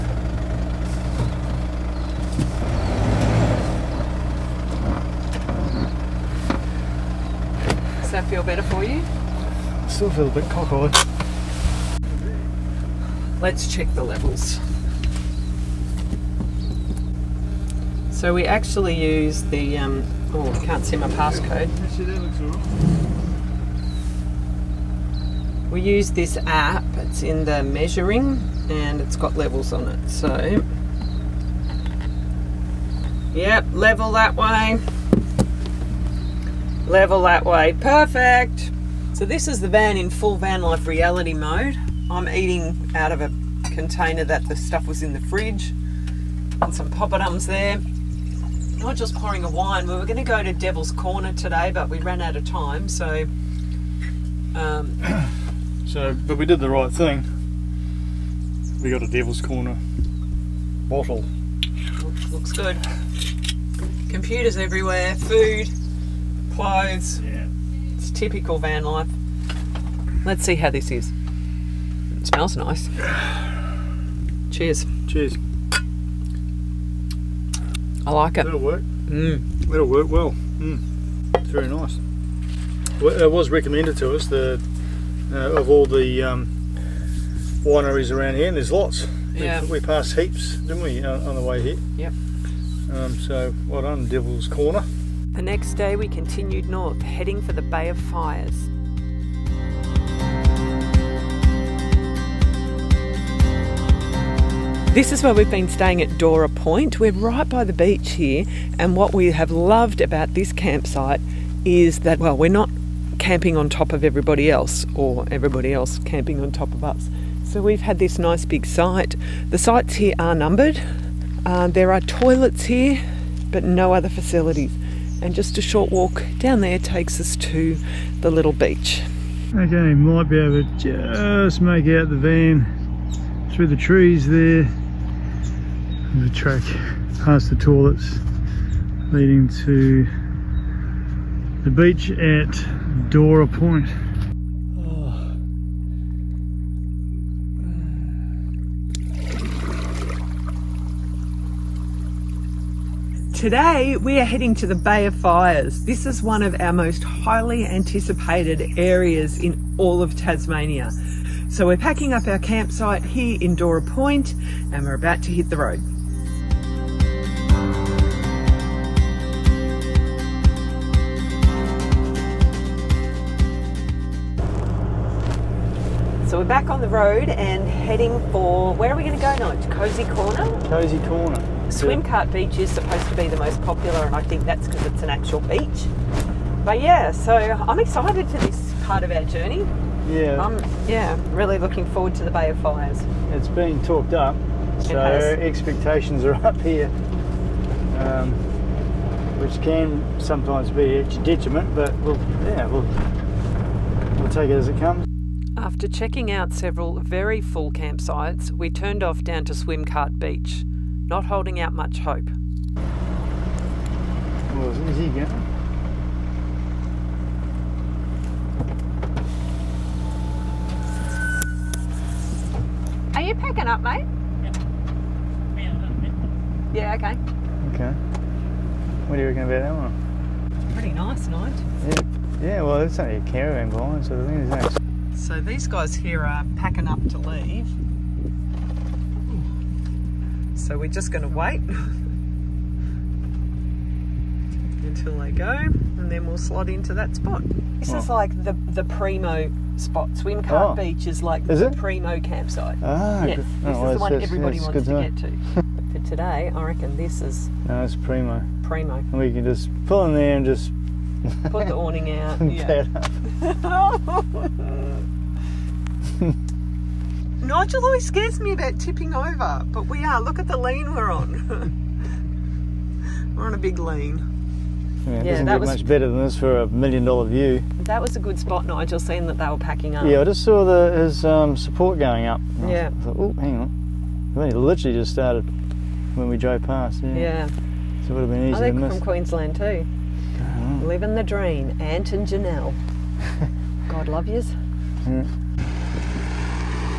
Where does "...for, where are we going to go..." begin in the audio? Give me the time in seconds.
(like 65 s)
178 s.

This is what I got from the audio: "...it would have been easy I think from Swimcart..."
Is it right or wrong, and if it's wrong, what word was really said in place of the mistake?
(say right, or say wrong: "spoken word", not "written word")
wrong: "Queensland", not "Swimcart".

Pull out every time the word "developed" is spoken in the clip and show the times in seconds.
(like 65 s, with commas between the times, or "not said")
not said.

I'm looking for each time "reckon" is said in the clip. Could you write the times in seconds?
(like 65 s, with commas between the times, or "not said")
229 s, 256 s.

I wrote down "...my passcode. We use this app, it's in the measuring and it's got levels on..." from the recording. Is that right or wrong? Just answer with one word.
right.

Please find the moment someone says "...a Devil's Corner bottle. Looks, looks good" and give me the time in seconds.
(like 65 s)
59 s.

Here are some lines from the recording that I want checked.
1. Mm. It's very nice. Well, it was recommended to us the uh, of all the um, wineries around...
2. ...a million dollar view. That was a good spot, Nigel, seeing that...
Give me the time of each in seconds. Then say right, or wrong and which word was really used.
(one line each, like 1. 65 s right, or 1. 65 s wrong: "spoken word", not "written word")
1. 80 s right
2. 276 s right.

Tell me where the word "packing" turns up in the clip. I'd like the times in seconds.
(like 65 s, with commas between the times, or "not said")
161 s, 223 s, 236 s, 279 s.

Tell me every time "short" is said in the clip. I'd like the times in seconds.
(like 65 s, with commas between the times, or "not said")
125 s.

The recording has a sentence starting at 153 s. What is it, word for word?
Today we are heading to the Bay of Fires.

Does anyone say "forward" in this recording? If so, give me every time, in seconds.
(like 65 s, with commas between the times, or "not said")
191 s.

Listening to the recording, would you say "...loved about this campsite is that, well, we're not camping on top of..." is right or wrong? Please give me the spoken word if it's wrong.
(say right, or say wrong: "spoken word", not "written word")
right.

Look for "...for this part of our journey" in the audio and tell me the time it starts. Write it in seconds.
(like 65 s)
188 s.